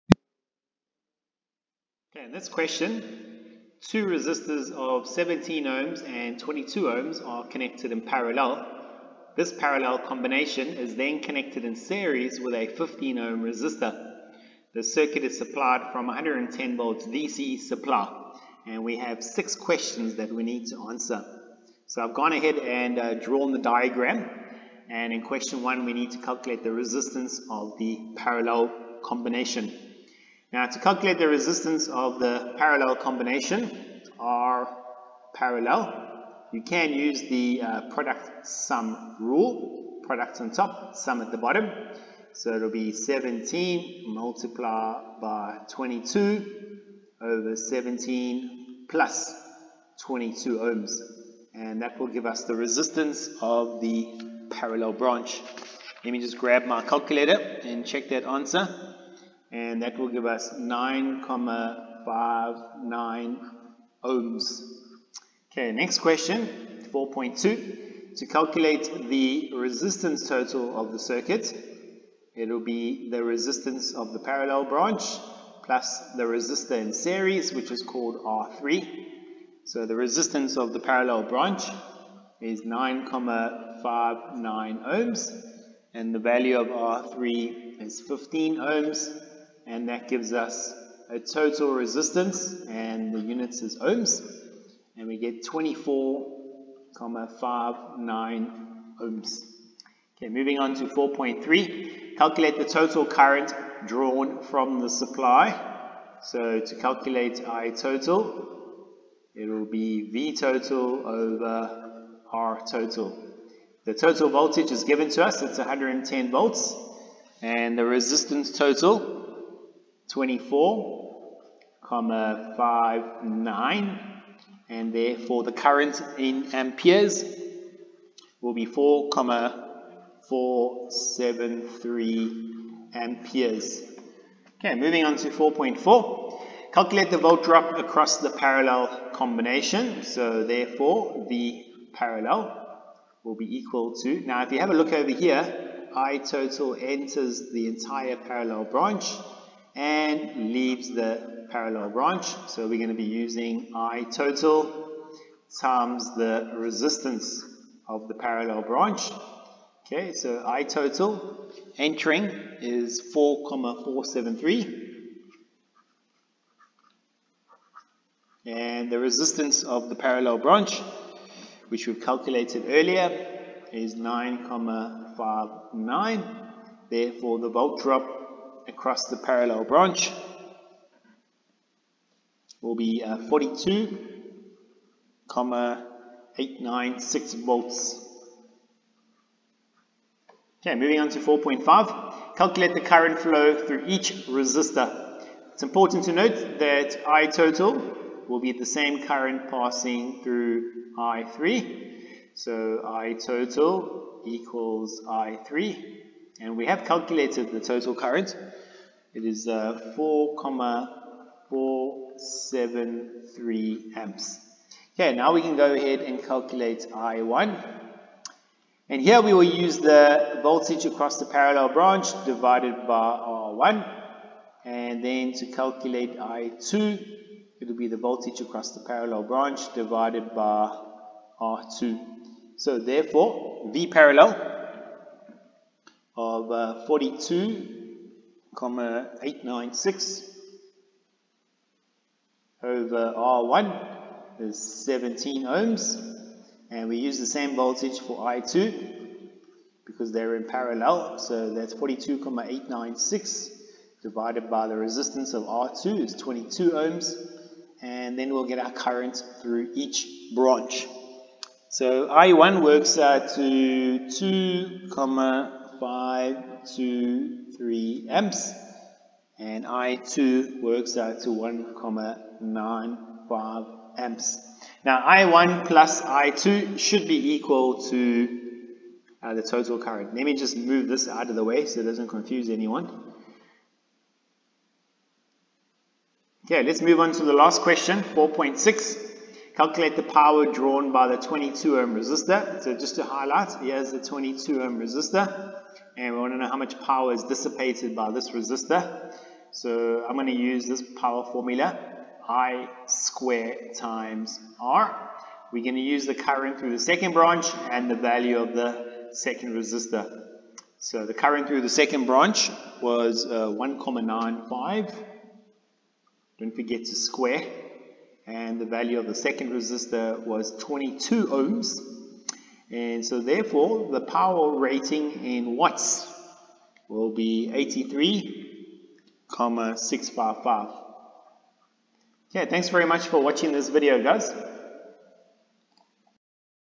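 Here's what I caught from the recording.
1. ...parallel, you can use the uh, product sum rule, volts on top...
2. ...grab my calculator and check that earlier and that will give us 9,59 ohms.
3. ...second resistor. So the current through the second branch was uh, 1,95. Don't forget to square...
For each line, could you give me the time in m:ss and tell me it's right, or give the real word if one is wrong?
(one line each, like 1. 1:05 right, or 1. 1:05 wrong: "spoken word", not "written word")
1. 0:35 wrong: "products", not "volts"
2. 0:56 wrong: "answer", not "earlier"
3. 5:09 right.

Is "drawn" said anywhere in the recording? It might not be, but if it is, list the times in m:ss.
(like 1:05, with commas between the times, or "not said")
0:23, 1:43, 4:50.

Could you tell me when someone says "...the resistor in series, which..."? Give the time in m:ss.
1:16.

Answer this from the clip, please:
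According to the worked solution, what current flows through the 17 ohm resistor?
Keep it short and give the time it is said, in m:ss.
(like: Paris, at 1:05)
2.523 amps, at 4:24.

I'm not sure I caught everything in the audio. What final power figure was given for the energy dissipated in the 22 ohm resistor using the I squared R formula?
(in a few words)
83.655 watts.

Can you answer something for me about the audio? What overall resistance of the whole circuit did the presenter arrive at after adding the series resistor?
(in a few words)
24.59 ohms.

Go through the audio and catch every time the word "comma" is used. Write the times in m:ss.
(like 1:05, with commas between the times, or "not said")
2:01, 2:09, 3:05, 3:58, 4:24, 4:31.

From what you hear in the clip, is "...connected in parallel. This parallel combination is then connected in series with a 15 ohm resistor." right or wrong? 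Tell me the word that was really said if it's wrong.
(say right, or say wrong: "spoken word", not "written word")
right.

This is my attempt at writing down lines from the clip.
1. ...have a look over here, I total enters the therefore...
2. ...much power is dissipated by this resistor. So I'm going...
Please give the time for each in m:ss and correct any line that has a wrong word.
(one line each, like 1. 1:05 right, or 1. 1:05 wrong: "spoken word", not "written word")
1. 2:24 wrong: "entire", not "therefore"
2. 4:56 right.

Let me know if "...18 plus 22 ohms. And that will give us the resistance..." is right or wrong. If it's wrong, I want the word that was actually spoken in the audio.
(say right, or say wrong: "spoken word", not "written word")
wrong: "17", not "18".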